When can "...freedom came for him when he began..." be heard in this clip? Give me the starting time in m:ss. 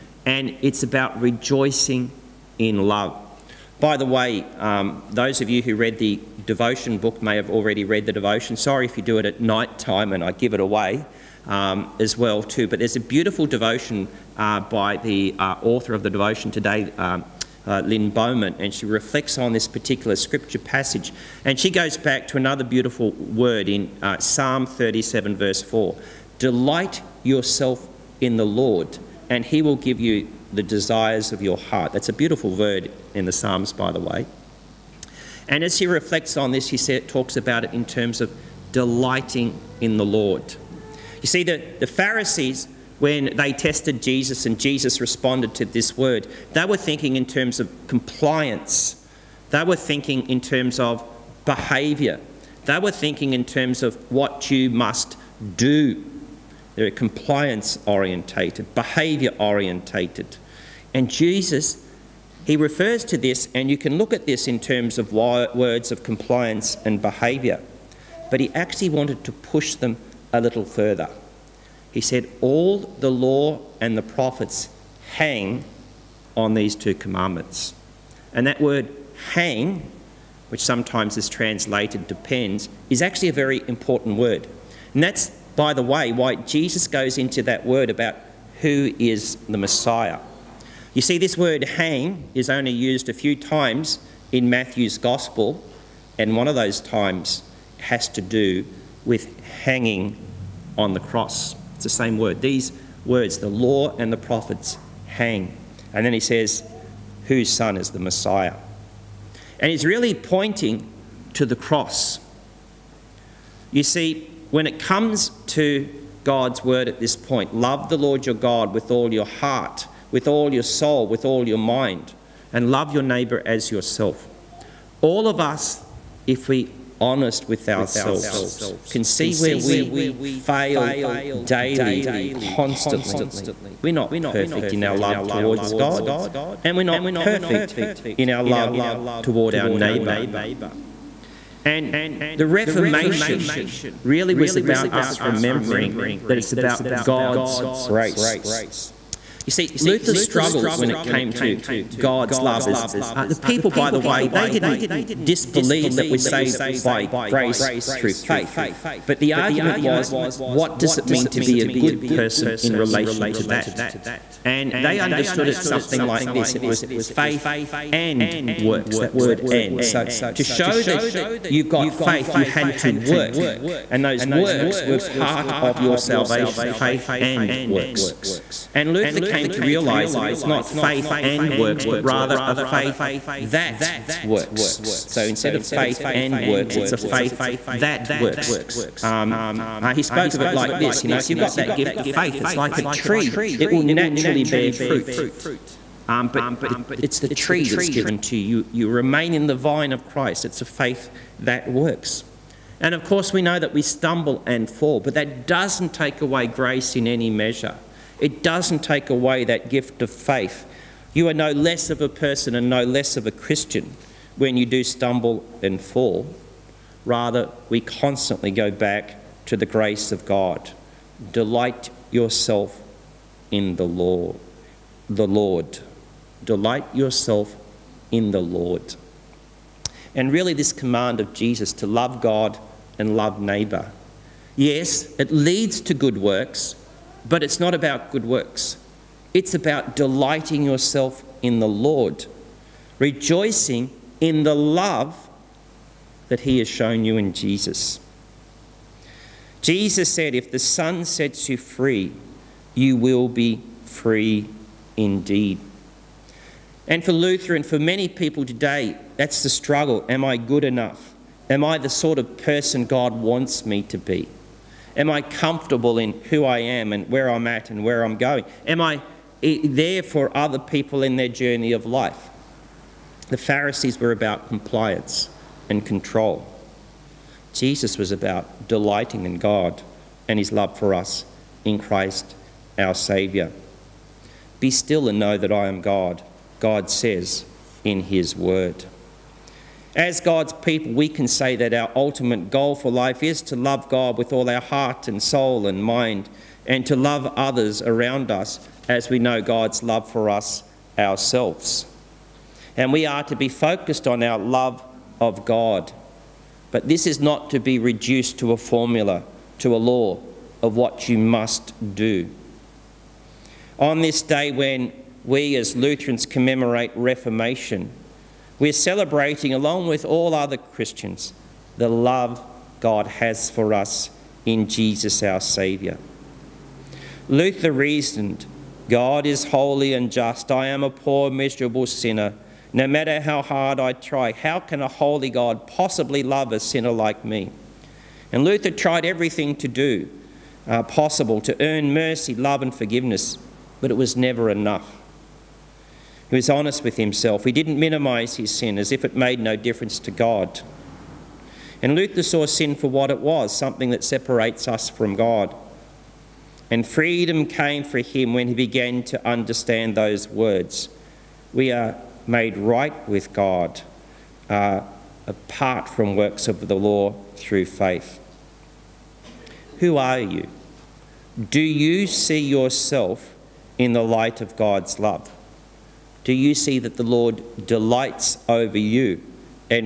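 5:56.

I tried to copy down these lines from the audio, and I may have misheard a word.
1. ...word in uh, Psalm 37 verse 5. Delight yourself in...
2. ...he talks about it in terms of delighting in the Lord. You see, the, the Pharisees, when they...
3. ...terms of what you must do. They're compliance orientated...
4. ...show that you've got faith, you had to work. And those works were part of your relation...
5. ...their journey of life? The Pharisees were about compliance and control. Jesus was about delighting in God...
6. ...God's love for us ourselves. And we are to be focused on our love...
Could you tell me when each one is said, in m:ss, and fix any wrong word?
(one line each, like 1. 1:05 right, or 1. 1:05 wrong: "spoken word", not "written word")
1. 0:23 wrong: "4", not "5"
2. 0:36 right
3. 0:53 right
4. 2:50 wrong: "salvation", not "relation"
5. 4:31 right
6. 4:59 right.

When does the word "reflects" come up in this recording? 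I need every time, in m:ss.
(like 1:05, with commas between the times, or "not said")
0:18, 0:35.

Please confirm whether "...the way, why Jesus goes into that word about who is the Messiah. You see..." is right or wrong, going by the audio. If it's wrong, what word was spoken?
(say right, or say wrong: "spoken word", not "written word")
right.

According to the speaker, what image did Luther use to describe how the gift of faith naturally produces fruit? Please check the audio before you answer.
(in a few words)
a tree.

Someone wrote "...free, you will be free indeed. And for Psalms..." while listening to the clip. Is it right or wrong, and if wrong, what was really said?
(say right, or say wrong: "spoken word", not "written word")
wrong: "Luther", not "Psalms".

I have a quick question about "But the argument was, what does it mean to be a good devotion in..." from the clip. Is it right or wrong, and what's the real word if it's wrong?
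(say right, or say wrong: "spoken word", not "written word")
wrong: "person", not "devotion".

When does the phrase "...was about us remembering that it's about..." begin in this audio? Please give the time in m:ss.
2:24.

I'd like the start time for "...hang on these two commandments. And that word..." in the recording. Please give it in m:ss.
1:15.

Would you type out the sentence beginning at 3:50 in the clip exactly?
And really, this command of Jesus to love God and love neighbour.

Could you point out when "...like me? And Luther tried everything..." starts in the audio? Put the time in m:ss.
5:36.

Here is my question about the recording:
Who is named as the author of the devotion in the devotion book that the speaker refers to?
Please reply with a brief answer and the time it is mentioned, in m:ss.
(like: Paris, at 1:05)
Lynn Bowman, at 0:17.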